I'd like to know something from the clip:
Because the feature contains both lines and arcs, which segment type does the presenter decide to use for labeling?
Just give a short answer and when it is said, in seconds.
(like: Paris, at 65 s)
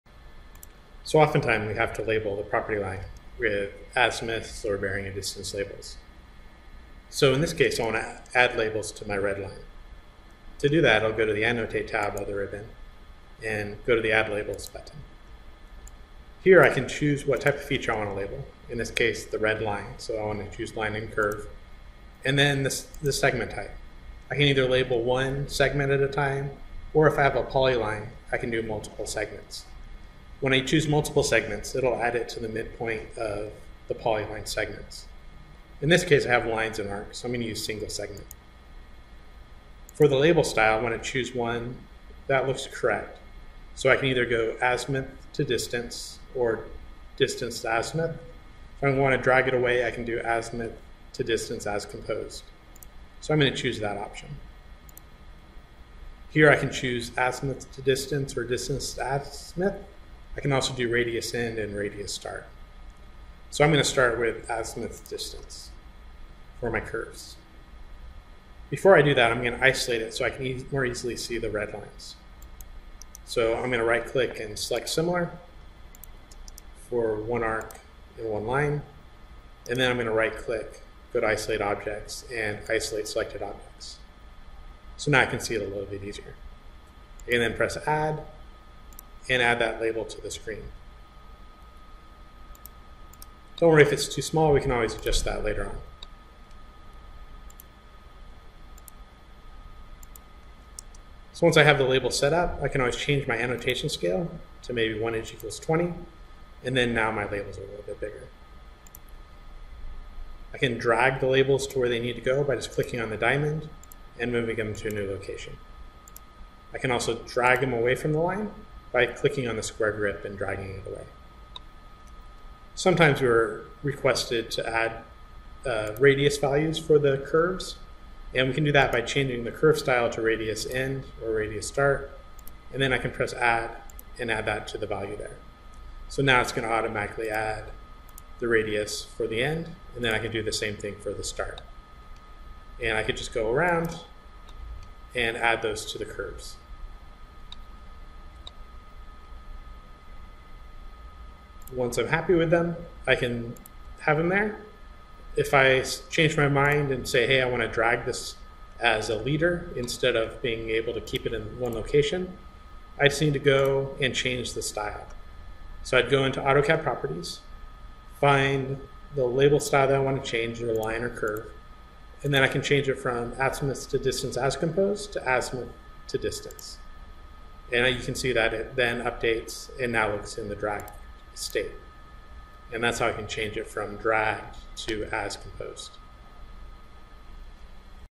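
single segment, at 37 s.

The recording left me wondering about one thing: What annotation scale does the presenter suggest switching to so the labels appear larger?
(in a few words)
1 inch equals 20.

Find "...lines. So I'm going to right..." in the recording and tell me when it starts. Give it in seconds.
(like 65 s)
71 s.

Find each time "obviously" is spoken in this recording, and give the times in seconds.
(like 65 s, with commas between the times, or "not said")
not said.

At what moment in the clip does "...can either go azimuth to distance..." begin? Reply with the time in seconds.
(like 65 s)
43 s.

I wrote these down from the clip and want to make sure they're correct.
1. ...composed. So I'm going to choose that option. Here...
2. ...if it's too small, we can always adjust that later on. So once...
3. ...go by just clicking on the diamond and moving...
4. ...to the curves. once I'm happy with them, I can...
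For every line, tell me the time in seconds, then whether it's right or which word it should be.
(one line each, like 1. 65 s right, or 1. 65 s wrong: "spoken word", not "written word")
1. 51 s right
2. 93 s right
3. 112 s right
4. 145 s right.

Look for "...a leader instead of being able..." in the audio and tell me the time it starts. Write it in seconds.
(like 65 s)
159 s.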